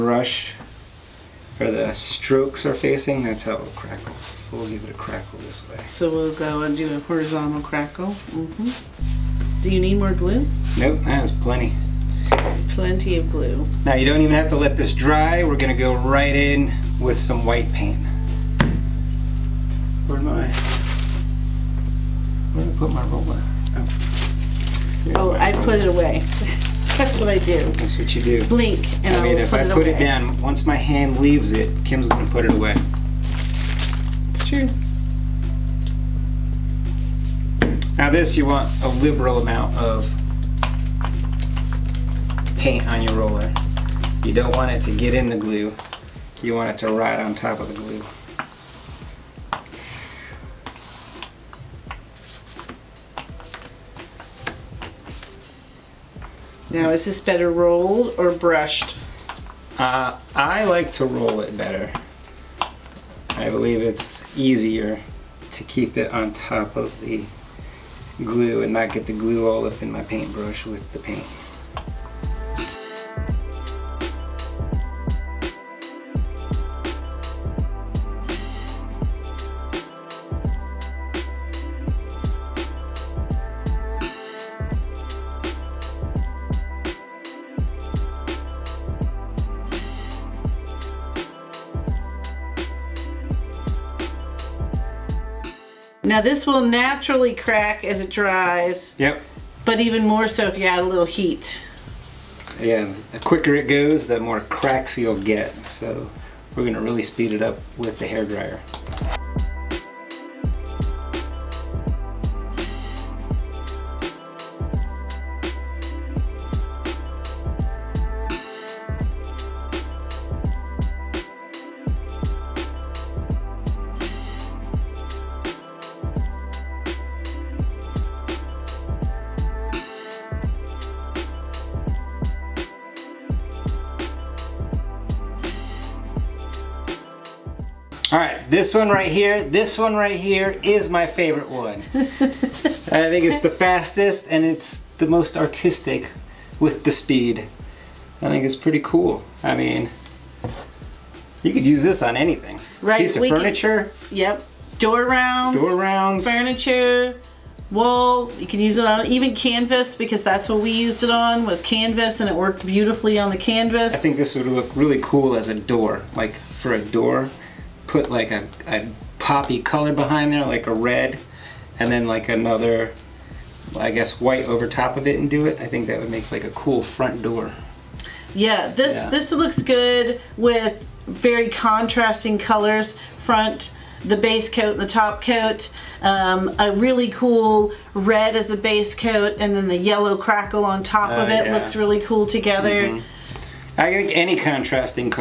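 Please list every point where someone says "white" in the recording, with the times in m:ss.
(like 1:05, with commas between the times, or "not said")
0:17, 2:54.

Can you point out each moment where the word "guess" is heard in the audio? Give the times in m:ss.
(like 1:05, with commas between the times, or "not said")
2:53.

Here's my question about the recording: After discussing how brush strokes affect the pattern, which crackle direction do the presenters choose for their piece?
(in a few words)
Horizontal.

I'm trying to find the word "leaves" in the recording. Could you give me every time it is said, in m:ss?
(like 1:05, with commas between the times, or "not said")
0:31.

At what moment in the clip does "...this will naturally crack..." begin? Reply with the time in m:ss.
1:36.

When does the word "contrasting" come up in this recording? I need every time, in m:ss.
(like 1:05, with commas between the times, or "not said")
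3:01, 3:14.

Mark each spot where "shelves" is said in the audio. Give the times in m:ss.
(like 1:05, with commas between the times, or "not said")
not said.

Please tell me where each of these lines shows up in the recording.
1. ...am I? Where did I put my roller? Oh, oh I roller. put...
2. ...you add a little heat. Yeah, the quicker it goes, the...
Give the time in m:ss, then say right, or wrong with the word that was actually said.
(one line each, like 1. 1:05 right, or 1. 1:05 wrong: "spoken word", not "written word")
1. 0:20 right
2. 1:40 right.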